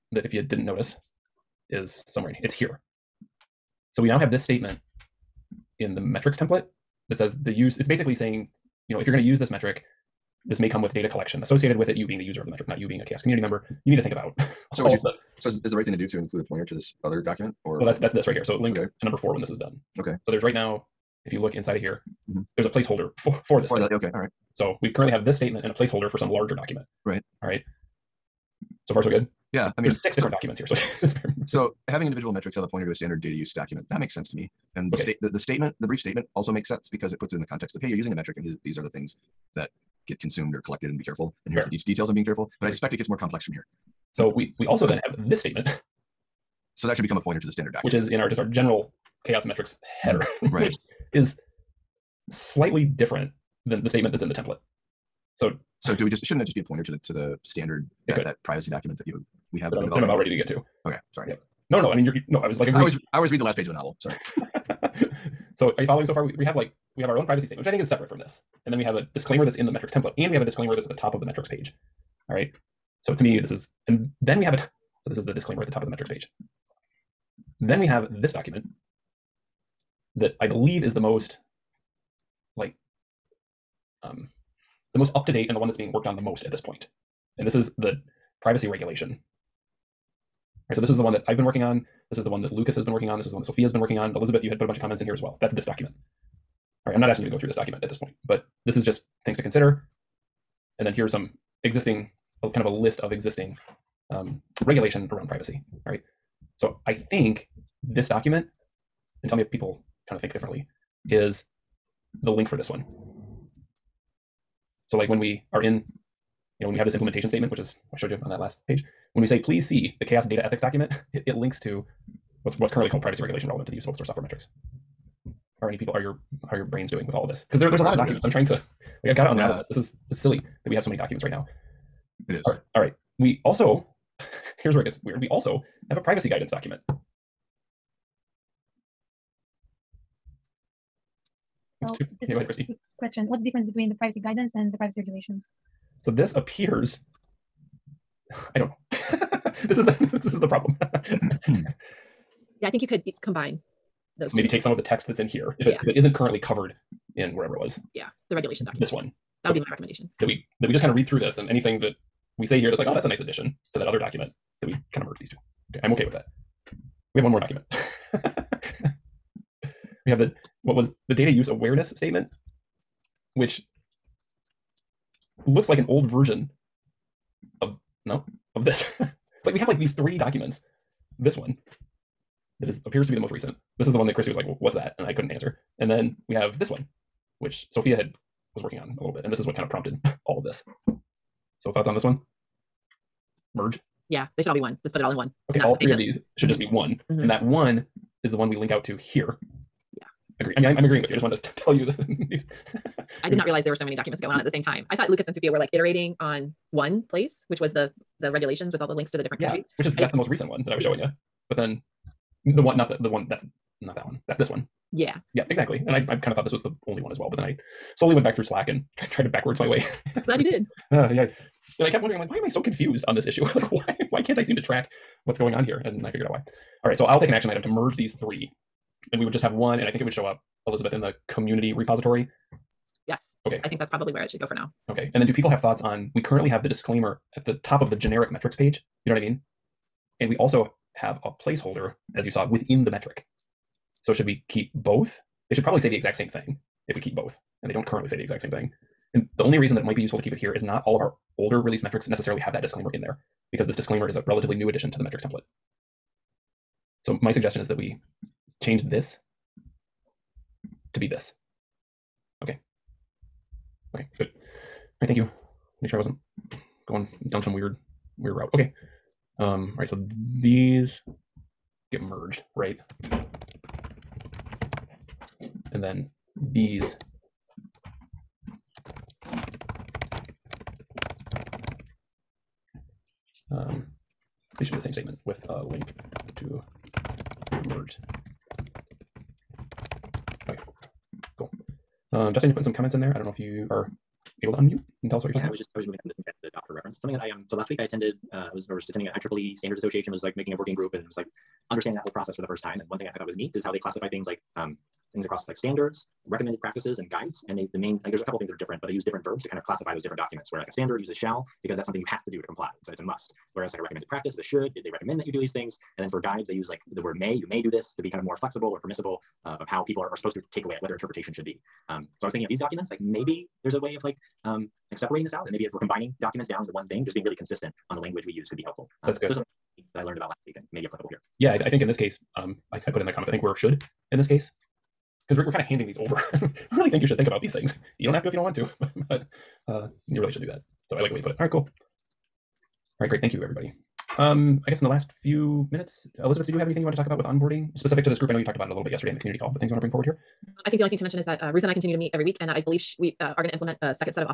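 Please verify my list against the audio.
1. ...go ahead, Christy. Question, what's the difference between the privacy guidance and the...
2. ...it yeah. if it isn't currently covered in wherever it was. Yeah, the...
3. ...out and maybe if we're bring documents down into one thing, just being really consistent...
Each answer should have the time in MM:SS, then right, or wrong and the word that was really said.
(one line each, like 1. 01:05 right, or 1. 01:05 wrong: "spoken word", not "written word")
1. 02:22 right
2. 02:35 right
3. 05:25 wrong: "combining", not "bring".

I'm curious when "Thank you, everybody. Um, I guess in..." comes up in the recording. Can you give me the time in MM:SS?
05:43.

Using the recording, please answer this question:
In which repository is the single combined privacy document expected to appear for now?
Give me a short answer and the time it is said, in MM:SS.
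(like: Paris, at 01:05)
community repository, at 03:51.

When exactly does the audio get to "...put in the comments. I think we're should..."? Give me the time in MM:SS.
05:32.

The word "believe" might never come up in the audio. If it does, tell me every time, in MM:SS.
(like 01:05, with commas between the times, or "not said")
01:20, 05:52.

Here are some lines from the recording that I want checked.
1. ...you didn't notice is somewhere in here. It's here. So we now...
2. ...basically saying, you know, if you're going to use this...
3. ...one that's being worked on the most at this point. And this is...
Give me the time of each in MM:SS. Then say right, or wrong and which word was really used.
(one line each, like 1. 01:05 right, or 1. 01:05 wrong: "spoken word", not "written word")
1. 00:00 right
2. 00:07 right
3. 01:25 right.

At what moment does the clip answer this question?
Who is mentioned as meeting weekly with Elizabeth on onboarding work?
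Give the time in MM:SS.
05:51.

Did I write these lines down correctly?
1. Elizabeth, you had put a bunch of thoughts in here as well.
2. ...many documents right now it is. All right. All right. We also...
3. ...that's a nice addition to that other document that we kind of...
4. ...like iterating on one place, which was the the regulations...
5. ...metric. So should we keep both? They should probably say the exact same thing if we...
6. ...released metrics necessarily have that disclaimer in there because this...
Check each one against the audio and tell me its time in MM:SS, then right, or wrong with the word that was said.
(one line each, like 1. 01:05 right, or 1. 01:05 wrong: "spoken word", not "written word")
1. 01:34 wrong: "comments", not "thoughts"
2. 02:10 right
3. 02:42 right
4. 03:25 right
5. 04:02 right
6. 04:11 right.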